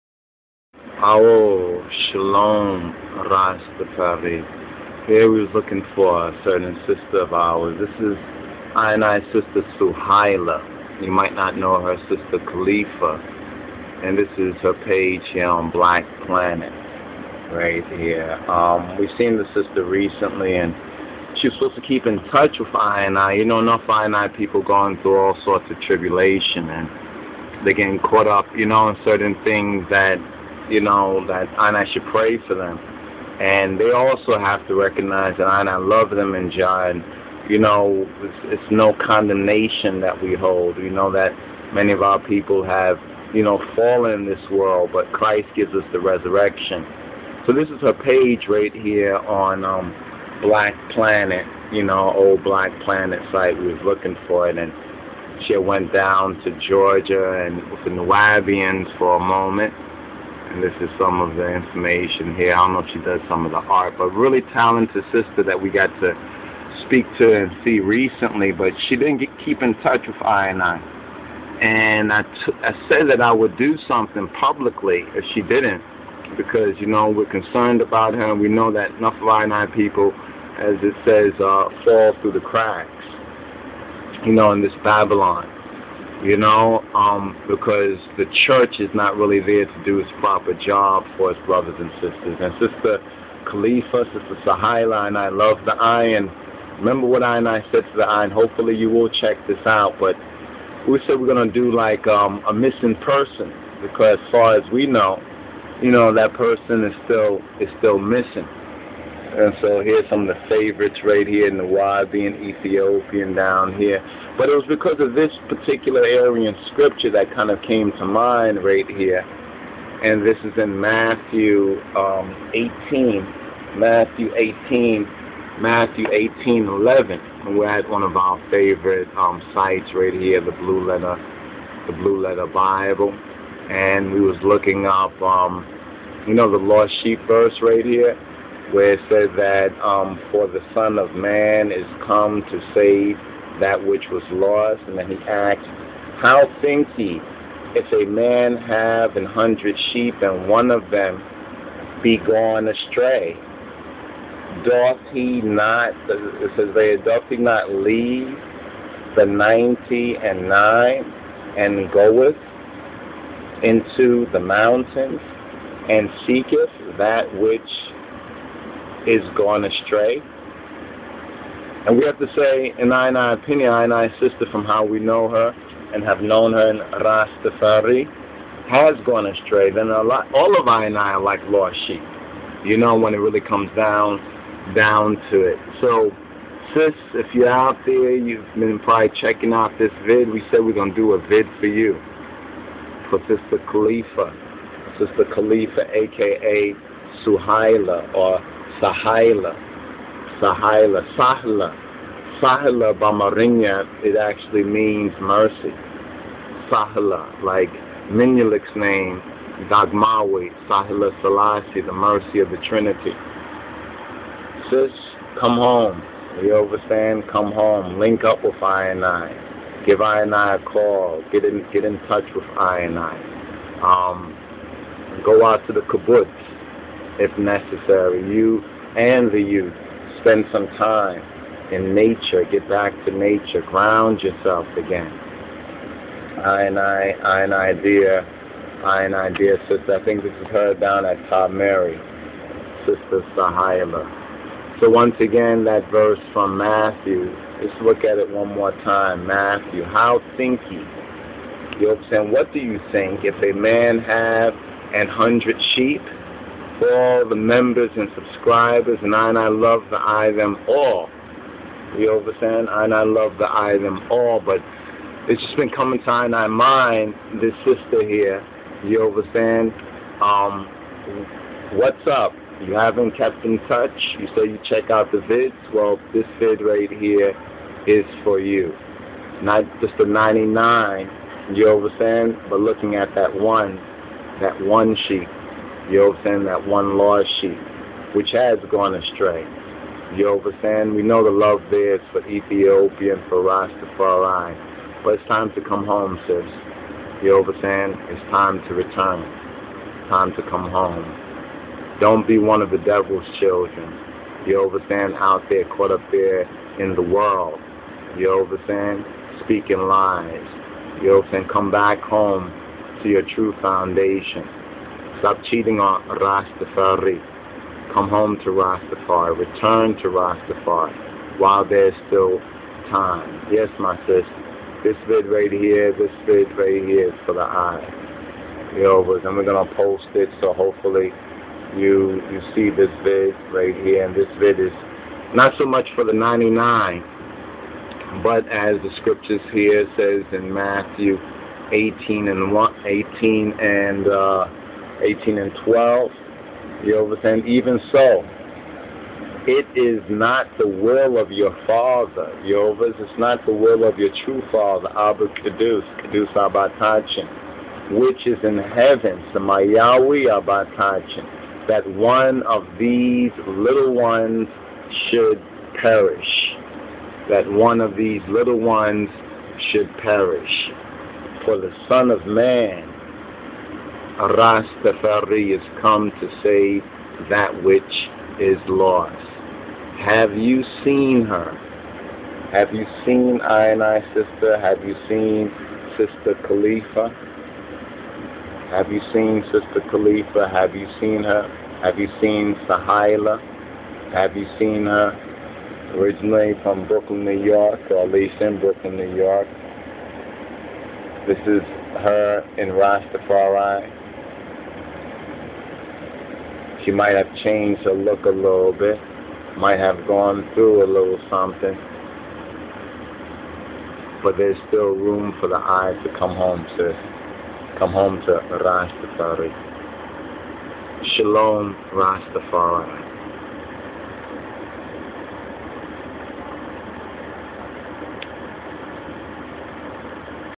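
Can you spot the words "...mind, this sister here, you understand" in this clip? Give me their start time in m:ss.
4:26.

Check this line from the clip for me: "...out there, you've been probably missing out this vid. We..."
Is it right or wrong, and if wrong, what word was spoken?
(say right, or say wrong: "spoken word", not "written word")
wrong: "checking", not "missing".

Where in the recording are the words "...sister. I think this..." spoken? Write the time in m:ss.
3:59.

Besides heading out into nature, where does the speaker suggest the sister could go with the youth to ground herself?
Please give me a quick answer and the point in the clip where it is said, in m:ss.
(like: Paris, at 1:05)
the kibbutz, at 3:45.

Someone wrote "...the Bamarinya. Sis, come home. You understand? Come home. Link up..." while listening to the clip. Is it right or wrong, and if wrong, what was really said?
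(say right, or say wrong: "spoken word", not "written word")
wrong: "Trinity", not "Bamarinya".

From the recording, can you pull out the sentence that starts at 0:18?
Um, we've seen the sister recently and she was supposed to keep in touch with I and I.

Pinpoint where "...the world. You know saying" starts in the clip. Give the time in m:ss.
5:06.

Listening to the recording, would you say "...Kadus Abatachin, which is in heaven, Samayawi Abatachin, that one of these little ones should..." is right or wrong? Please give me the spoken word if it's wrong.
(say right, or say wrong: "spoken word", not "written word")
right.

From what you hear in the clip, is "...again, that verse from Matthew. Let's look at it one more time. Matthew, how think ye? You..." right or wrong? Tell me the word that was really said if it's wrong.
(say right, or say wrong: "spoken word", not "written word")
right.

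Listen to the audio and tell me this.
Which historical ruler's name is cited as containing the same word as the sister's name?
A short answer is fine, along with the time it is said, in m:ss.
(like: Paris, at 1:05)
Menelik, at 3:28.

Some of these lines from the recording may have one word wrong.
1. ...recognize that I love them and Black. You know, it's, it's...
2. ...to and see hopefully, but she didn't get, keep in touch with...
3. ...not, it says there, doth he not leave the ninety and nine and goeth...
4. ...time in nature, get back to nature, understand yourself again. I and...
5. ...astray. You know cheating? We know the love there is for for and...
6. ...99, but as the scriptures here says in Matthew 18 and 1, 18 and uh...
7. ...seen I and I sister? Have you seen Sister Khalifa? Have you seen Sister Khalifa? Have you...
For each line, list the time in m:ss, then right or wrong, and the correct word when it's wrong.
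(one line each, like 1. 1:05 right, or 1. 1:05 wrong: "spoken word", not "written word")
1. 0:34 wrong: "John", not "Black"
2. 1:07 wrong: "recently", not "hopefully"
3. 2:35 right
4. 3:50 wrong: "ground", not "understand"
5. 4:48 wrong: "saying", not "cheating"
6. 5:36 right
7. 6:23 right.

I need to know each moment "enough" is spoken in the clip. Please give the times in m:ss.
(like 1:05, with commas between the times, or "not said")
0:23, 1:18.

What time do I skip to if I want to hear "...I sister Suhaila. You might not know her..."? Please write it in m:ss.
0:09.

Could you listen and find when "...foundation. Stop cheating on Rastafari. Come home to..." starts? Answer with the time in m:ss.
5:13.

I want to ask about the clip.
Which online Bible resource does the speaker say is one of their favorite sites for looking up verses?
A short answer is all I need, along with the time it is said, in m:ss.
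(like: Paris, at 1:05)
Blue Letter Bible, at 2:11.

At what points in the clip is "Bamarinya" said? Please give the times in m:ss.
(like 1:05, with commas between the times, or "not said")
3:22.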